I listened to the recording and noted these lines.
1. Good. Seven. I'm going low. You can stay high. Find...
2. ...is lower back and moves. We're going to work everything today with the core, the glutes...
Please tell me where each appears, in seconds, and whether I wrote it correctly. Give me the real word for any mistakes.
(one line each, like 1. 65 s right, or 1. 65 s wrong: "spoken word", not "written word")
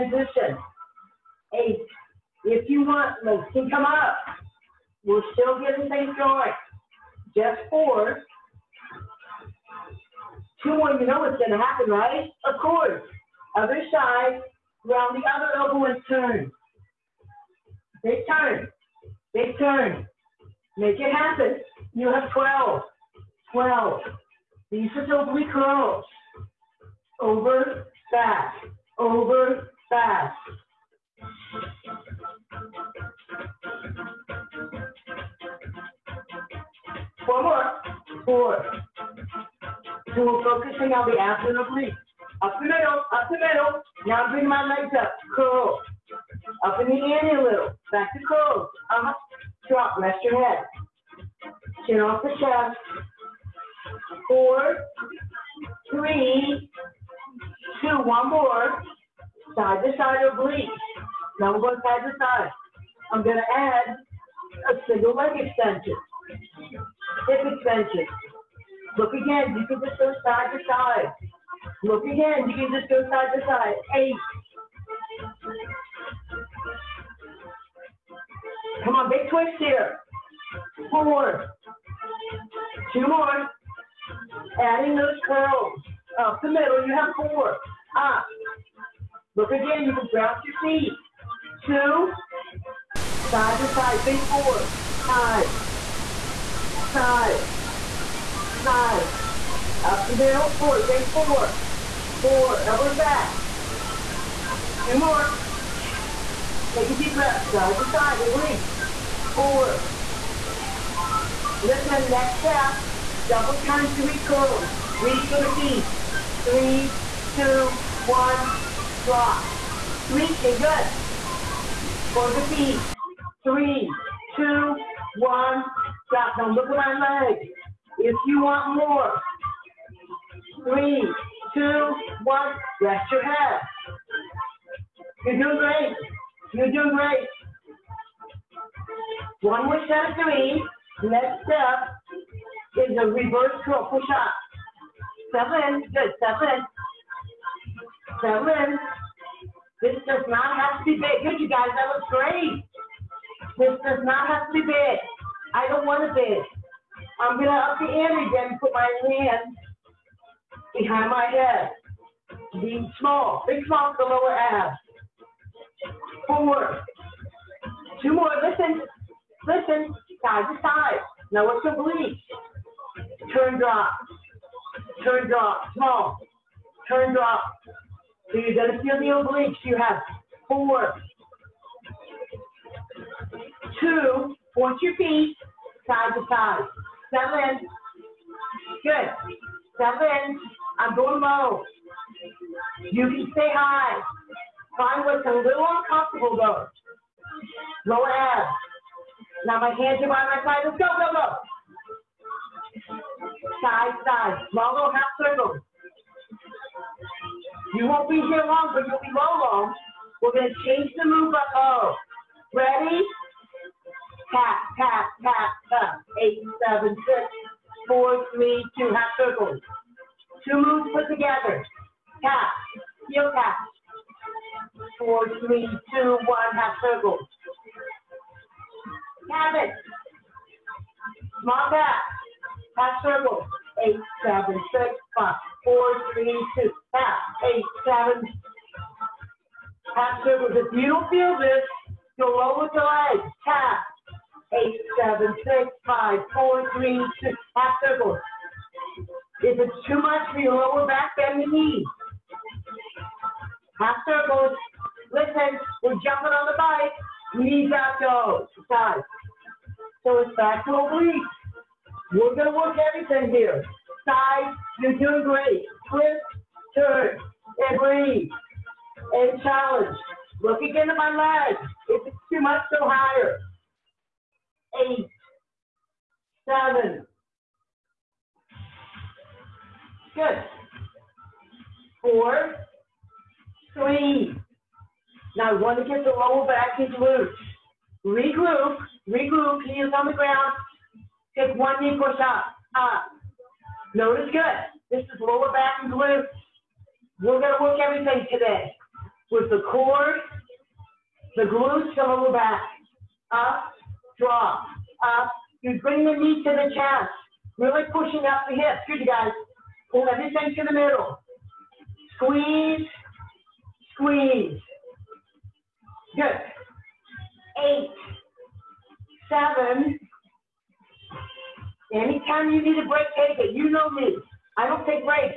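1. 188 s right
2. 295 s wrong: "glutes", not "moves".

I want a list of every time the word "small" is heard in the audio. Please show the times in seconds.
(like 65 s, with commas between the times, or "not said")
162 s, 175 s, 231 s.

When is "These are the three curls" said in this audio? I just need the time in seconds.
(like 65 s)
24 s.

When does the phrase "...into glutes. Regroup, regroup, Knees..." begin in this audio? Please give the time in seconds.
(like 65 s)
286 s.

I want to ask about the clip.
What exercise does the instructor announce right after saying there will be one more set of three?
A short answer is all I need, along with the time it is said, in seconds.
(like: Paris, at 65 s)
reverse curl push-up, at 143 s.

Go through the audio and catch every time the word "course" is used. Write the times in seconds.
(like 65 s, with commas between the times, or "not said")
12 s.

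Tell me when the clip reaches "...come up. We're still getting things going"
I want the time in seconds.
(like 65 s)
3 s.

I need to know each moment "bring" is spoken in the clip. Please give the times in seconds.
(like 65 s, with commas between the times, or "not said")
44 s, 305 s.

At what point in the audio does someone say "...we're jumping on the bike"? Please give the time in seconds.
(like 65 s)
255 s.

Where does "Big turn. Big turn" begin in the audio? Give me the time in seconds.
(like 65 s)
18 s.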